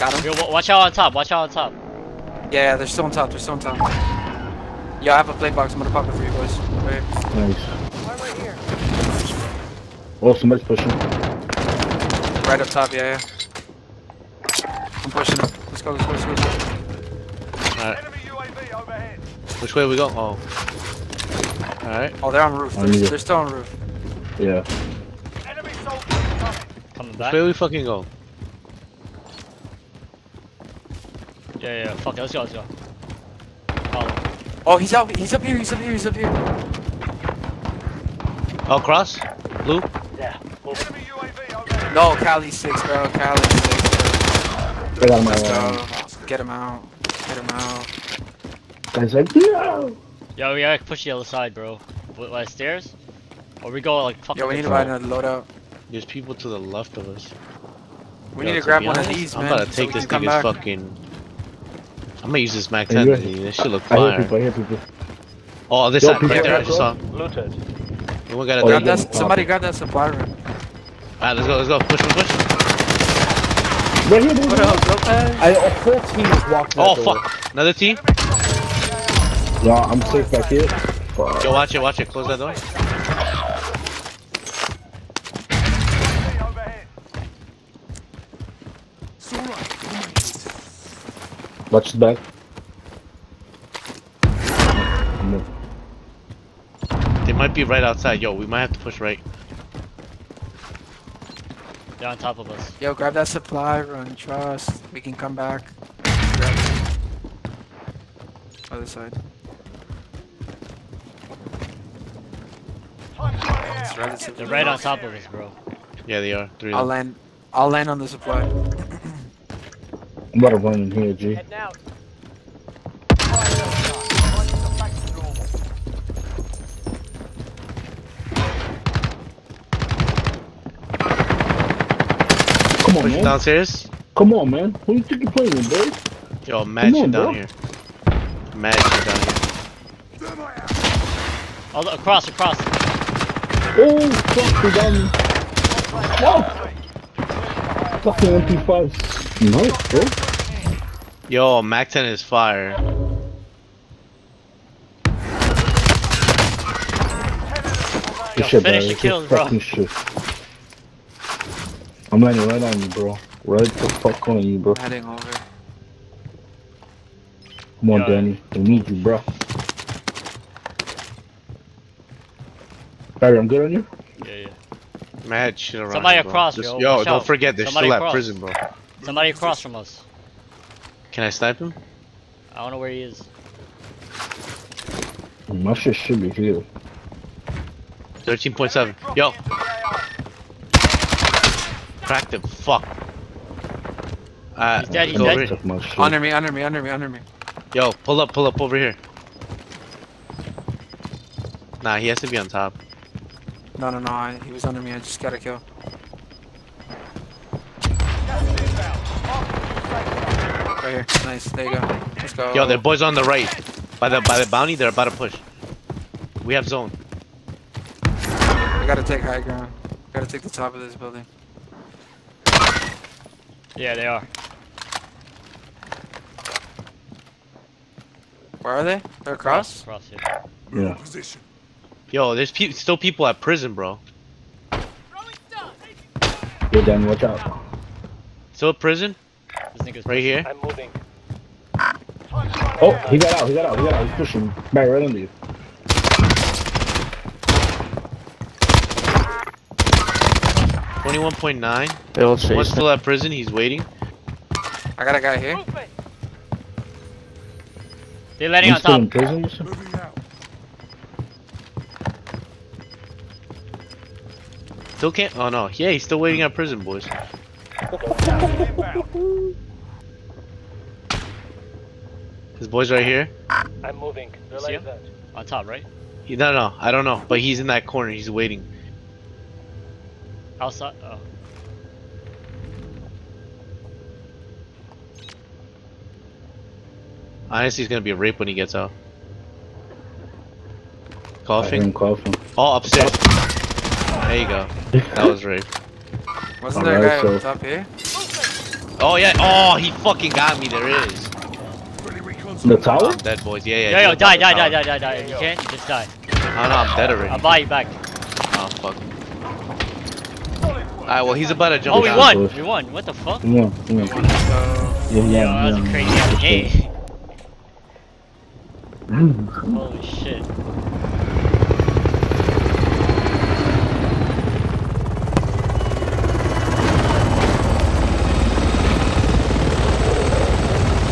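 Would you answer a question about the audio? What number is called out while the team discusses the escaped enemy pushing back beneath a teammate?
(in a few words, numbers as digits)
21.9.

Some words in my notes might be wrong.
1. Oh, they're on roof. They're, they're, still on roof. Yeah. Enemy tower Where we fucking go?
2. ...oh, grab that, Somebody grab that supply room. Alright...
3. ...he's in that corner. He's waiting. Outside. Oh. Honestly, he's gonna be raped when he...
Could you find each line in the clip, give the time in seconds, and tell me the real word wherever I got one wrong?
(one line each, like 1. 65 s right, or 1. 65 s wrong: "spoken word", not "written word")
1. 22 s wrong: "soldier", not "tower"
2. 68 s right
3. 277 s right.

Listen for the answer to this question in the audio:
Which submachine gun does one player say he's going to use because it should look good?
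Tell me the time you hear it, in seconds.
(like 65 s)
62 s.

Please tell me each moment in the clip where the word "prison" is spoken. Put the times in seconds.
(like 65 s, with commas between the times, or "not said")
178 s, 233 s, 238 s, 253 s, 259 s, 266 s.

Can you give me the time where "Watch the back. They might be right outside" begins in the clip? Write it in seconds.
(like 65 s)
91 s.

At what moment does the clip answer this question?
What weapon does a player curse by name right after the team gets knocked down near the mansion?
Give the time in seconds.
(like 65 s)
148 s.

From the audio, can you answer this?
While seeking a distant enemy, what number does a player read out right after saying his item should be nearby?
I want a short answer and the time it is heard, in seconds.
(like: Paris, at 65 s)
13.7, at 188 s.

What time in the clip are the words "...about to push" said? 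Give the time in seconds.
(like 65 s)
214 s.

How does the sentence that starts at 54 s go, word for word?
Yeah, we need to find a loadout.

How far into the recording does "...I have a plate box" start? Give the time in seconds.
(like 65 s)
5 s.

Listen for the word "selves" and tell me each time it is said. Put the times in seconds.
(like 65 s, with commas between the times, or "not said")
not said.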